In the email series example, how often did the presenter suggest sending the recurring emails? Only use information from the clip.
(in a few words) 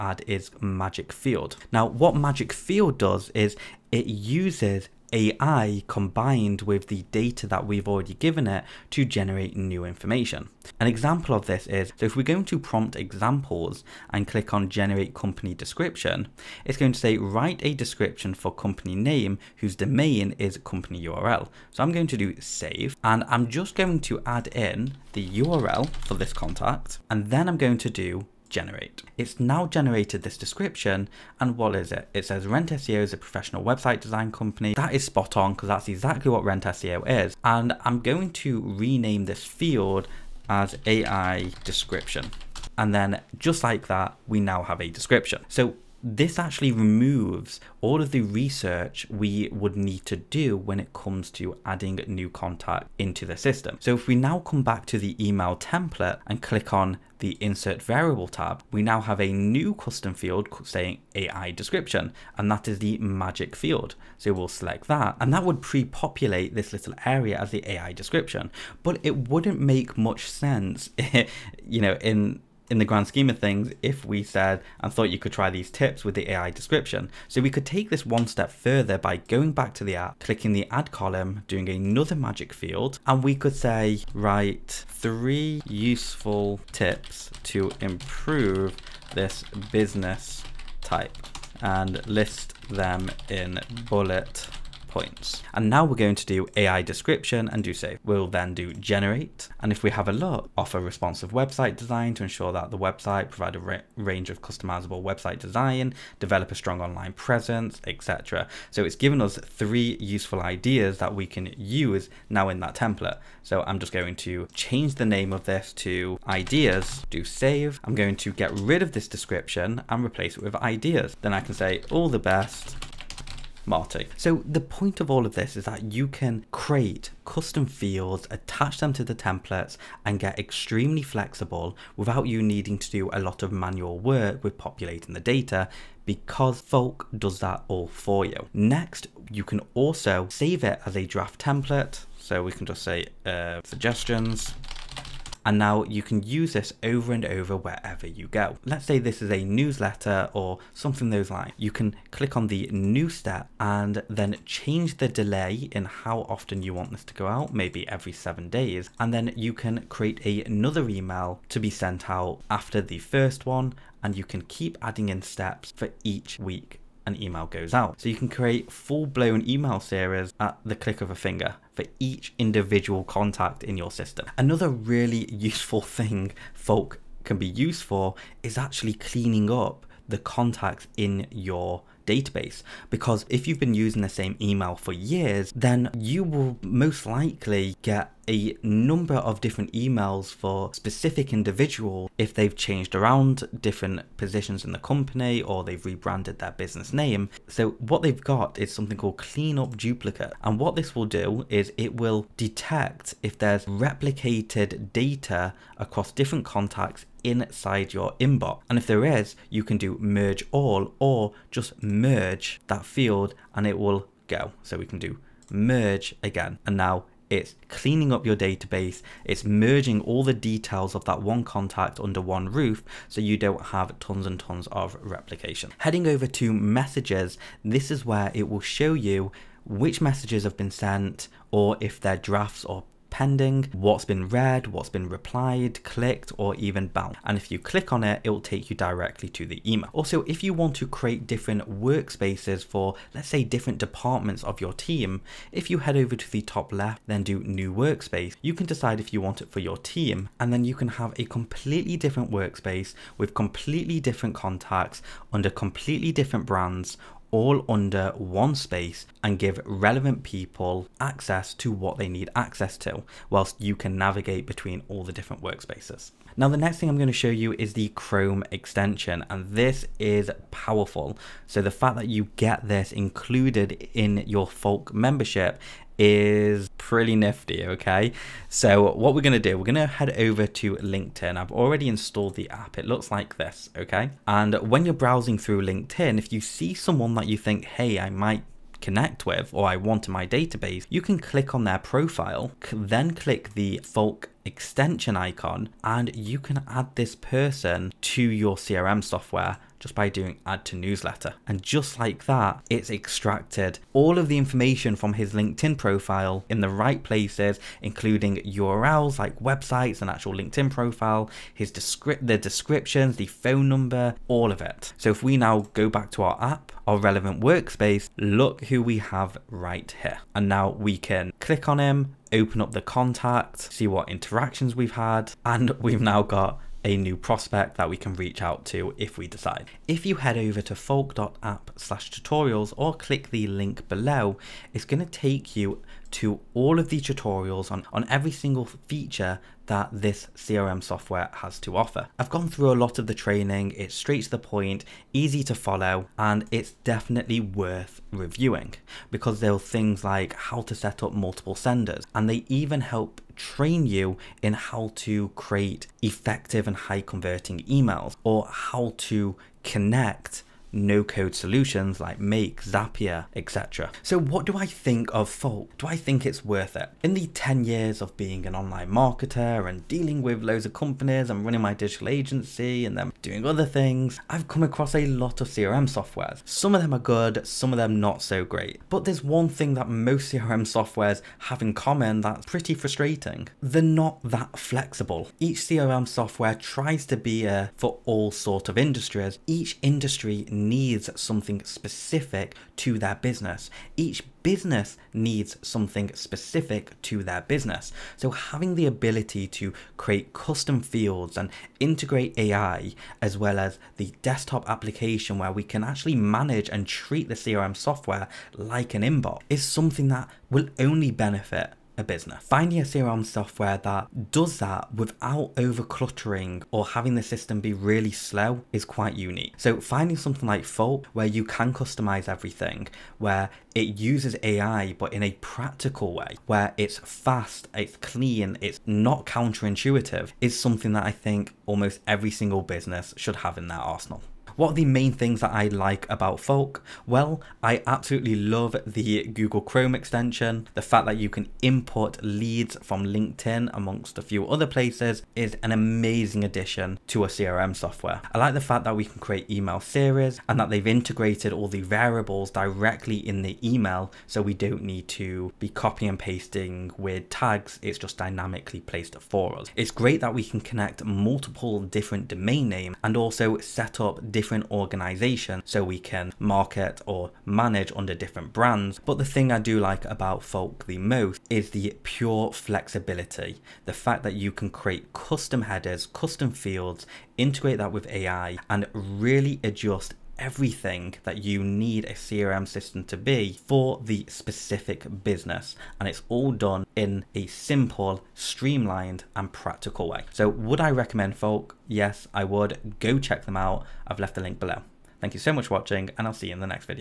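every 7 days.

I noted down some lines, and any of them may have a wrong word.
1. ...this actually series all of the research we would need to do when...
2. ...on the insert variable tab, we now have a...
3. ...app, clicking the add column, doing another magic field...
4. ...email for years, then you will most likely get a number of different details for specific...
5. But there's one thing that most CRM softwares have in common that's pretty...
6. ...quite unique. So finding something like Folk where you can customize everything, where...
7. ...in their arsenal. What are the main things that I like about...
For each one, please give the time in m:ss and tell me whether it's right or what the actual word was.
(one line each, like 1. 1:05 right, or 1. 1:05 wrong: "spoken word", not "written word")
1. 0:46 wrong: "removes", not "series"
2. 0:56 right
3. 1:19 right
4. 3:04 wrong: "emails", not "details"
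5. 6:18 right
6. 6:58 right
7. 7:13 right.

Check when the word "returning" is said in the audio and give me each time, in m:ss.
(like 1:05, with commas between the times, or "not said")
not said.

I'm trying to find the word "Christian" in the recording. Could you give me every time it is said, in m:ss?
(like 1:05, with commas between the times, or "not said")
not said.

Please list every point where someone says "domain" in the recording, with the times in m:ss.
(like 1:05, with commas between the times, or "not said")
0:19, 7:42.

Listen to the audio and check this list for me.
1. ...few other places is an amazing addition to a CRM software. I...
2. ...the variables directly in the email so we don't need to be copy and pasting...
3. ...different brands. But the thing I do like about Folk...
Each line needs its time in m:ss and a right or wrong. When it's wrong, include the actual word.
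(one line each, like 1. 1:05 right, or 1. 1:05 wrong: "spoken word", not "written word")
1. 7:24 right
2. 7:31 right
3. 7:48 right.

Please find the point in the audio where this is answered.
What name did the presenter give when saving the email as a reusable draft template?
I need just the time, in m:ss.
2:23.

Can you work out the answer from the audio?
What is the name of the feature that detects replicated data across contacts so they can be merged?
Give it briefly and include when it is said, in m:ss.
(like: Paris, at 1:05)
clean up duplicate, at 3:19.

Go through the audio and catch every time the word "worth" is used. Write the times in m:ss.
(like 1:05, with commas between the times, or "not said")
5:47, 6:06.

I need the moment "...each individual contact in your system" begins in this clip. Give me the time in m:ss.
2:51.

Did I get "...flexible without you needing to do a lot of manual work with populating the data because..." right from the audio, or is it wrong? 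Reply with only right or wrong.
right.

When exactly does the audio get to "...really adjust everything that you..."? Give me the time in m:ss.
7:58.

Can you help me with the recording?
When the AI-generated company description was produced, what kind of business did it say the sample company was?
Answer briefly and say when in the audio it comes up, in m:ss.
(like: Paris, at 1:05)
professional website design company, at 0:33.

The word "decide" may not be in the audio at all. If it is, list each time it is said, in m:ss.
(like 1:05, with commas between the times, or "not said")
4:08, 5:29.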